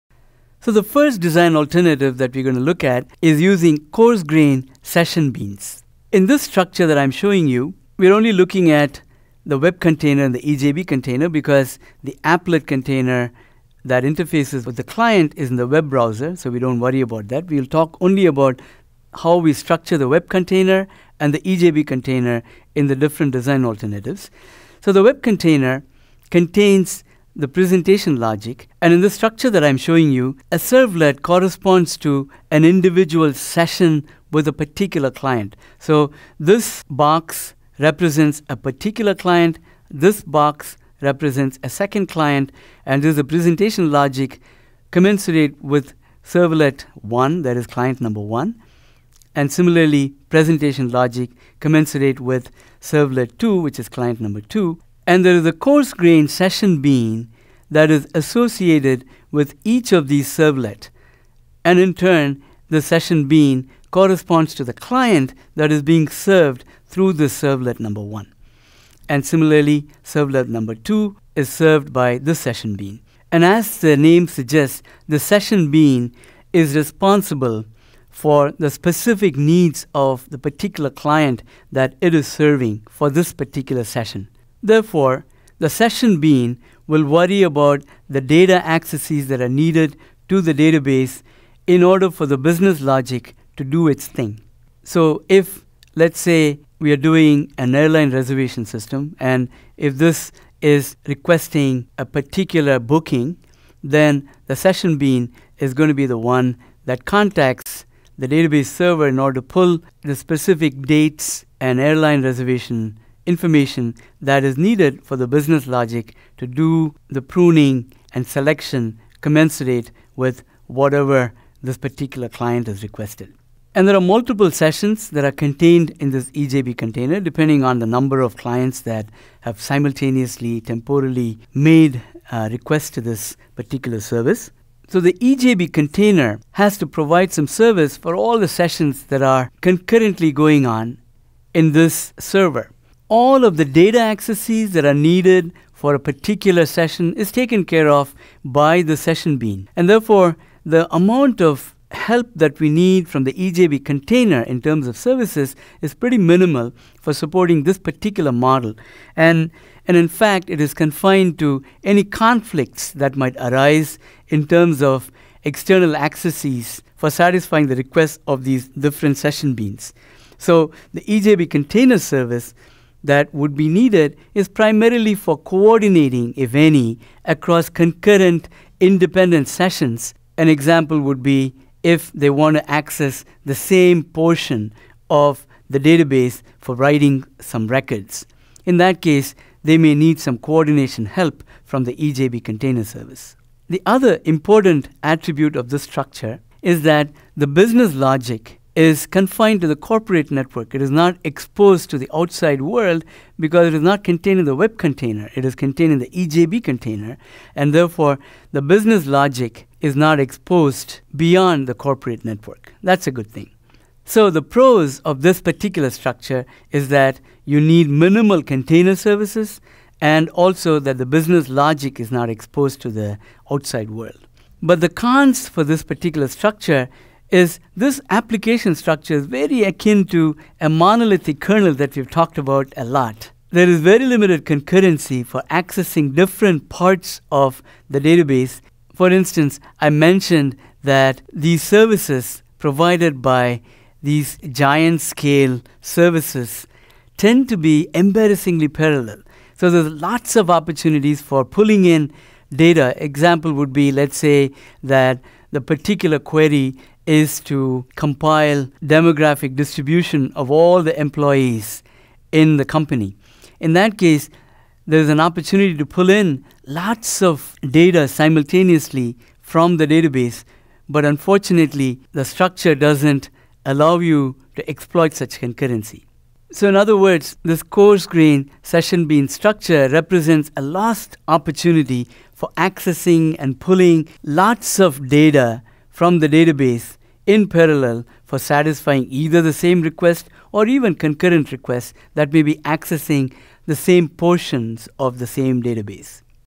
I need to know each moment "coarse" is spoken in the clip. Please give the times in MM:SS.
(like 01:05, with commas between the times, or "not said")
00:03, 00:55, 04:37.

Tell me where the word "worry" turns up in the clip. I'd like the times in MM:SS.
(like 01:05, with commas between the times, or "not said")
00:16, 01:27.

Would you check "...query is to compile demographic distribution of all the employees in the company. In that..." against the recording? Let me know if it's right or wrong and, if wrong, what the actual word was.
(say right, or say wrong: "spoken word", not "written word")
right.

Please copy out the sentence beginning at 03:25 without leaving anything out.
It is contained in the EJB container, and therefore the business logic is not exposed beyond the corporate network.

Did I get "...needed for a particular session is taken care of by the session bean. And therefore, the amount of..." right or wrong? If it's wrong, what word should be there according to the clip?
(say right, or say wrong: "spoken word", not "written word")
right.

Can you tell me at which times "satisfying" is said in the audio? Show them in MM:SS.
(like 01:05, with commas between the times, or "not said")
02:47, 04:48.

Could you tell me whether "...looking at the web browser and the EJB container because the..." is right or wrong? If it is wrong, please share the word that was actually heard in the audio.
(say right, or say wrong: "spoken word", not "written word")
wrong: "container", not "browser".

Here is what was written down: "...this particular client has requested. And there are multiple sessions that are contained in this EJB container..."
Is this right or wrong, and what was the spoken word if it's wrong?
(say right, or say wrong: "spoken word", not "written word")
right.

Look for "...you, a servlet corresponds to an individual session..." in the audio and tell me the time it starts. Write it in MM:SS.
00:30.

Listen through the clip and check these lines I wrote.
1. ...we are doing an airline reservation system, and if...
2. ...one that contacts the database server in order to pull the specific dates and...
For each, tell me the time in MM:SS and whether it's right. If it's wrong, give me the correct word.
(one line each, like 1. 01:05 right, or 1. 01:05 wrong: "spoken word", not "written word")
1. 01:36 right
2. 01:46 right.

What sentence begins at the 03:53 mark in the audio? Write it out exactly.
There is very limited concurrency for accessing different parts of the database.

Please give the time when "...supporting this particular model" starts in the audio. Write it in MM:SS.
02:37.